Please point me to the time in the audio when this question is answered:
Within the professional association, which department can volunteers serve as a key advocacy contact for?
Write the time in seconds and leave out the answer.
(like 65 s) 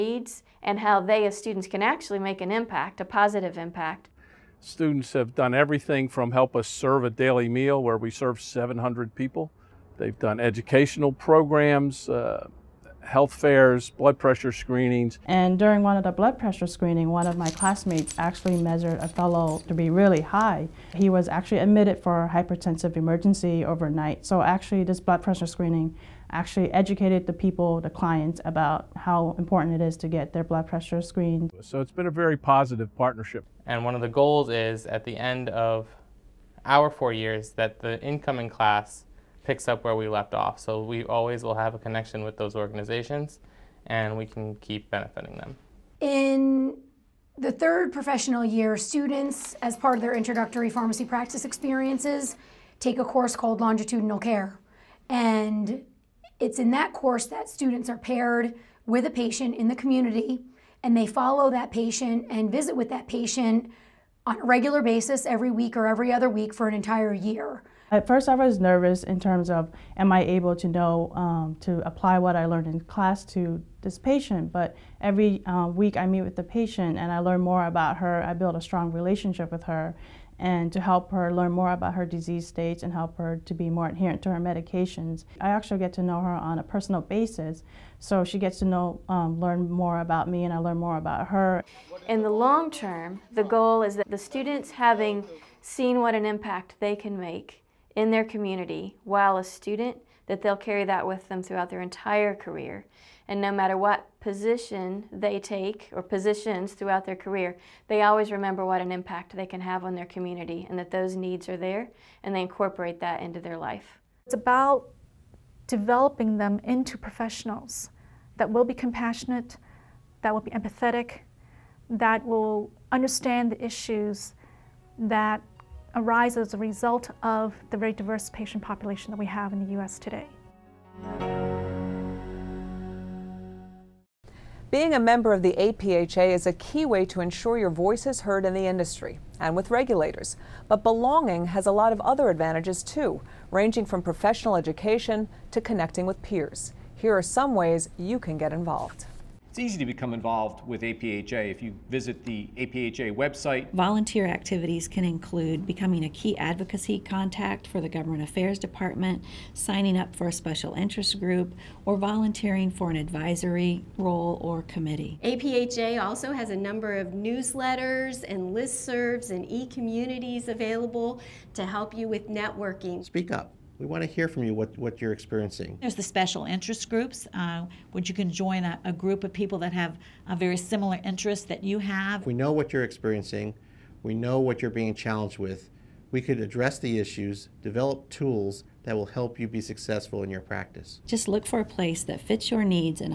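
157 s.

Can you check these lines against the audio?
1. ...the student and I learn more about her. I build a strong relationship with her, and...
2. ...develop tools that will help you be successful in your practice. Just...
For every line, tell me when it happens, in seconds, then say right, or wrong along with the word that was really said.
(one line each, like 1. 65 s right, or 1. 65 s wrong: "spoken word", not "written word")
1. 76 s wrong: "patient", not "student"
2. 187 s right.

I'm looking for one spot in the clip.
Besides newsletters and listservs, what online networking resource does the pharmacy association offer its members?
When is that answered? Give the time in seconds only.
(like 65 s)
169 s.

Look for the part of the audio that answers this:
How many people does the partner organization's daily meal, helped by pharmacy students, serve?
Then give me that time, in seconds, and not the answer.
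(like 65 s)
8 s.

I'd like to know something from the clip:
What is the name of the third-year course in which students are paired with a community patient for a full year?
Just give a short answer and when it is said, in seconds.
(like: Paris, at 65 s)
Longitudinal Care, at 53 s.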